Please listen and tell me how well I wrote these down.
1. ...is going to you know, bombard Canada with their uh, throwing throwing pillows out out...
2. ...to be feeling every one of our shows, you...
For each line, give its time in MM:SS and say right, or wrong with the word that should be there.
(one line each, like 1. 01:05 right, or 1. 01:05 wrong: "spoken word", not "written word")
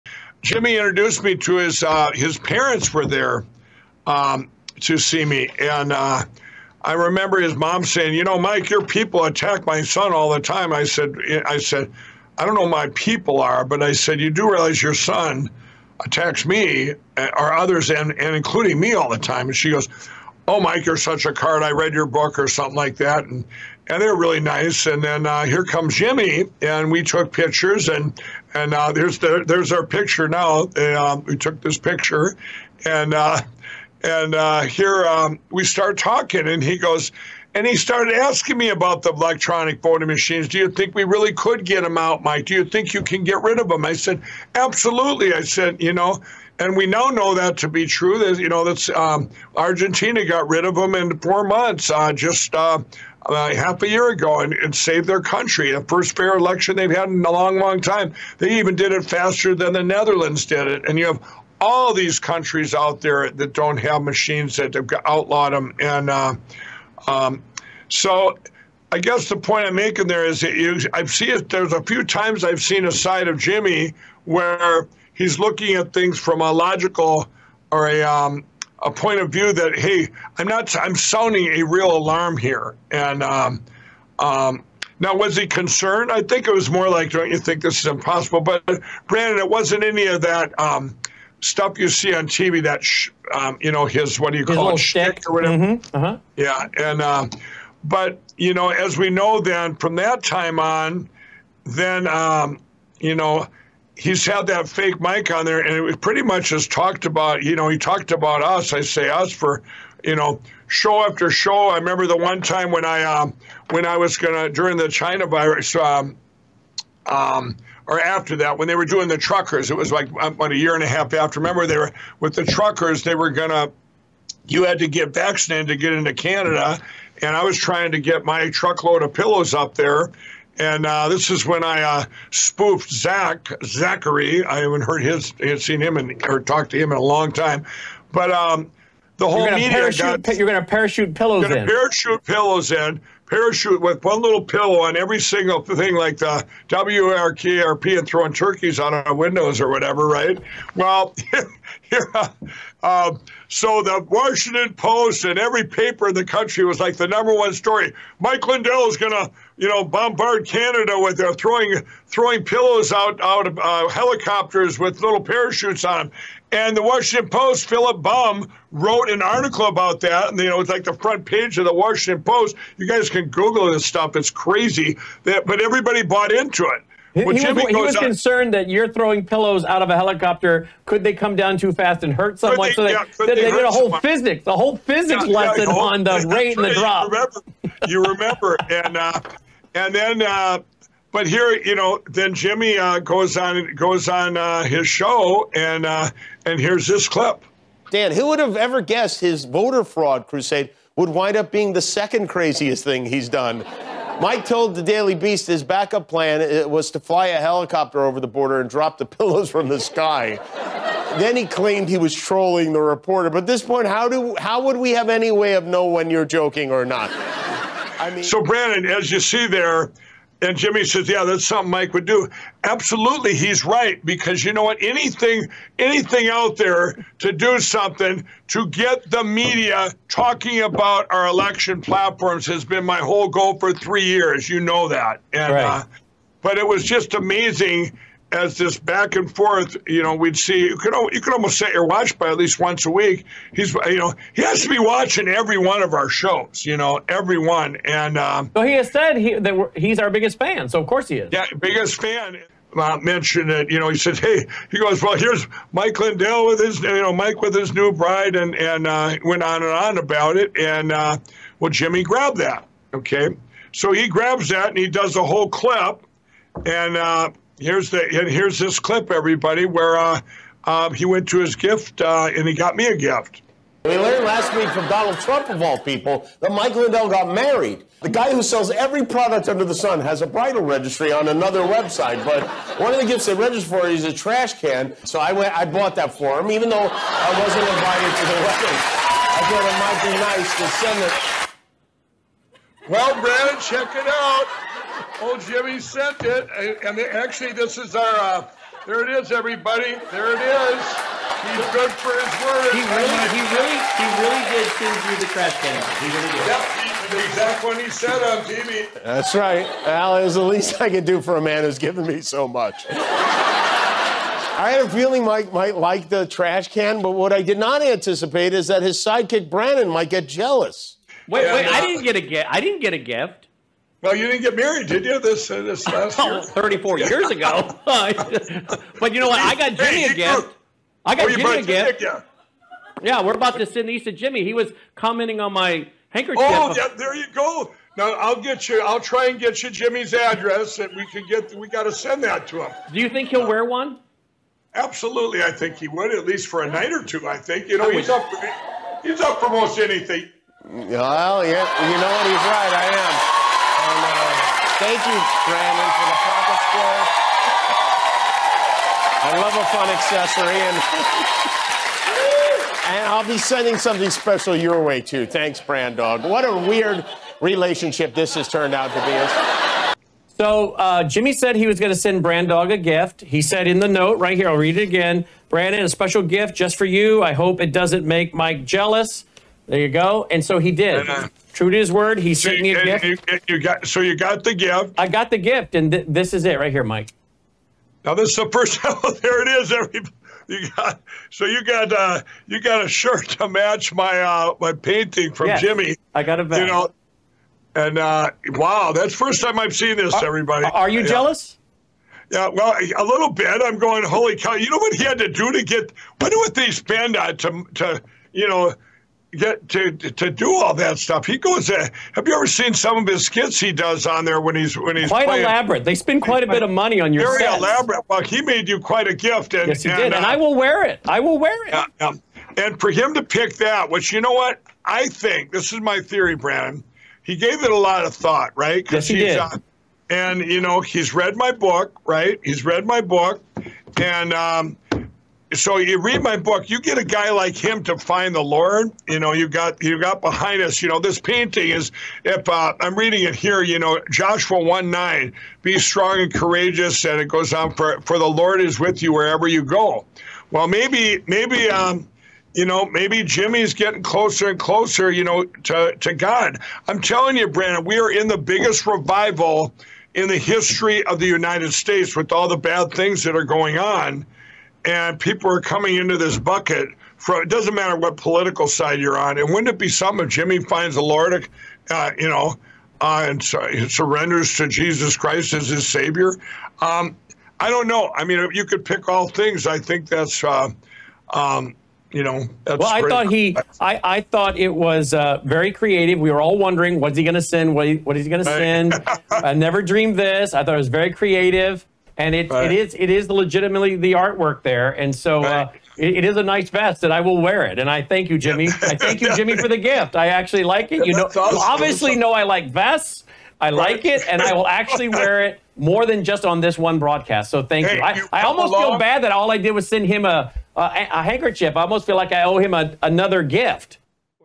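1. 02:38 right
2. 04:04 wrong: "watching", not "feeling".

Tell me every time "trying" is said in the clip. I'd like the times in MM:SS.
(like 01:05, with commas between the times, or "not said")
02:07.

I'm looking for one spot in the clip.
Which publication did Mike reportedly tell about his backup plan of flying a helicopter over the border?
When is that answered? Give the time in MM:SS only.
03:24.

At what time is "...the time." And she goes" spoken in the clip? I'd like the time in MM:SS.
00:19.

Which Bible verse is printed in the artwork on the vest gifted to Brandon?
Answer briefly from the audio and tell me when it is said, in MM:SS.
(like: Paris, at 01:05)
Joshua 1:9, at 07:24.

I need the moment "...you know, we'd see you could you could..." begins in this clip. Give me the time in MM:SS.
03:59.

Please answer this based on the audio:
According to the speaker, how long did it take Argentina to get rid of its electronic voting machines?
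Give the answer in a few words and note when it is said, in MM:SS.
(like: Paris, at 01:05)
4 months, at 00:51.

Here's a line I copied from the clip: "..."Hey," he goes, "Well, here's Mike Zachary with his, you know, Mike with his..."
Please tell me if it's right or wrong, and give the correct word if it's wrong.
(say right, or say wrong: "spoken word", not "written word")
wrong: "Lindell", not "Zachary".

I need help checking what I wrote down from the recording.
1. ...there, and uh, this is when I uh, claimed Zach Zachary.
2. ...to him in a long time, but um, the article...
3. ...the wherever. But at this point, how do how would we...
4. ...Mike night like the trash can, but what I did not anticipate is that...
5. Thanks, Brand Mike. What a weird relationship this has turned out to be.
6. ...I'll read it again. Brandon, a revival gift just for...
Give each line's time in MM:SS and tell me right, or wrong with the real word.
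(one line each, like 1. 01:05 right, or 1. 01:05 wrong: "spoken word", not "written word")
1. 02:09 wrong: "spoofed", not "claimed"
2. 02:16 wrong: "whole", not "article"
3. 03:32 wrong: "reporter", not "wherever"
4. 05:15 wrong: "might", not "night"
5. 06:05 wrong: "Dog", not "Mike"
6. 06:14 wrong: "special", not "revival".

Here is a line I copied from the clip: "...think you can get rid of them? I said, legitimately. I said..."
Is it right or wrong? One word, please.
wrong.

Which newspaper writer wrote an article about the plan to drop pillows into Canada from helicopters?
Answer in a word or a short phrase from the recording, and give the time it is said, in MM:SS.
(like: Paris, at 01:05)
Philip Bump, at 02:47.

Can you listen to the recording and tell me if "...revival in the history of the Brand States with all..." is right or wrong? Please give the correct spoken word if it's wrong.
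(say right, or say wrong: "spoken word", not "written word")
wrong: "United", not "Brand".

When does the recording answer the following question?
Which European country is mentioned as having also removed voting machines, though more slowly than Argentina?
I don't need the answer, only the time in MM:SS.
00:59.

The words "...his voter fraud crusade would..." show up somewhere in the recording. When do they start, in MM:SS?
03:19.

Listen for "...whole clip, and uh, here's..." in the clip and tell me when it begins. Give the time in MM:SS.
04:25.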